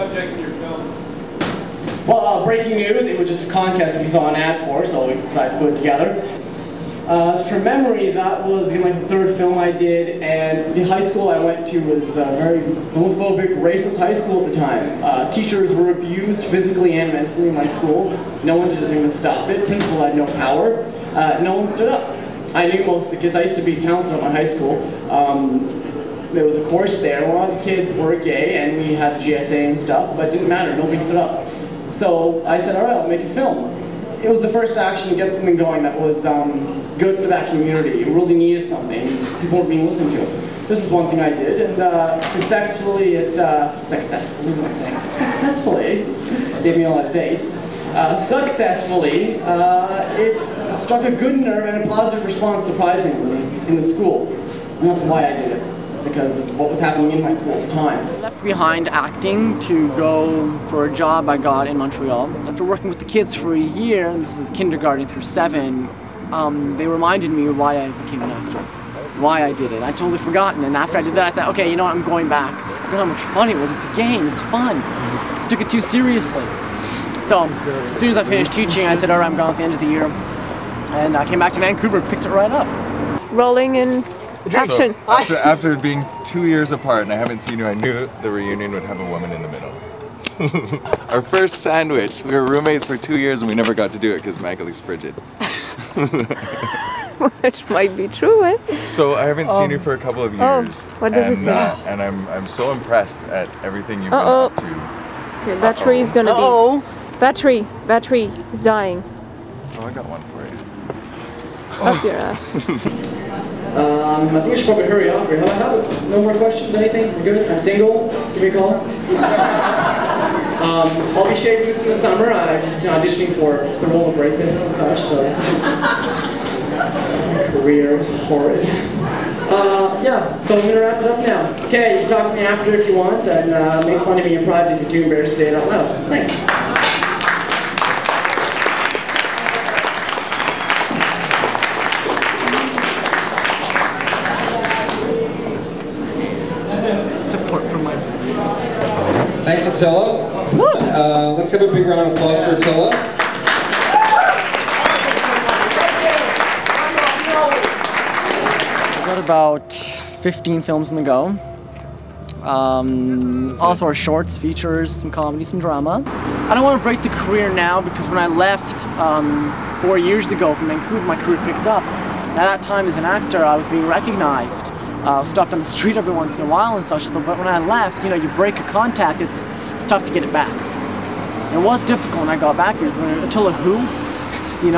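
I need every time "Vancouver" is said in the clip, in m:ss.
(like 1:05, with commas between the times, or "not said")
1:21, 2:50.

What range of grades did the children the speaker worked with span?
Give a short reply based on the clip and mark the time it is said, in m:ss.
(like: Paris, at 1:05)
Kindergarten through 7, at 1:04.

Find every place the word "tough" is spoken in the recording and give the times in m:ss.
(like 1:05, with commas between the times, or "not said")
2:59.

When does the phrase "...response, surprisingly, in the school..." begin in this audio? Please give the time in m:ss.
0:52.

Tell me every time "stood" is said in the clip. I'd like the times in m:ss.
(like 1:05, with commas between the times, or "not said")
0:21, 0:30.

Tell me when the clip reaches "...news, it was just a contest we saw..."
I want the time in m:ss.
0:02.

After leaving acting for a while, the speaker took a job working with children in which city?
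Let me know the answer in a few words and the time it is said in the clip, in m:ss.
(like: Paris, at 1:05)
Montreal, at 1:01.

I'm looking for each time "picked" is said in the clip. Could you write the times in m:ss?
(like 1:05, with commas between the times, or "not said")
1:22, 2:51.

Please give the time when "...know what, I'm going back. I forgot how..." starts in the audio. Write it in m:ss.
1:11.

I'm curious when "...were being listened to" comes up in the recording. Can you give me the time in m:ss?
0:39.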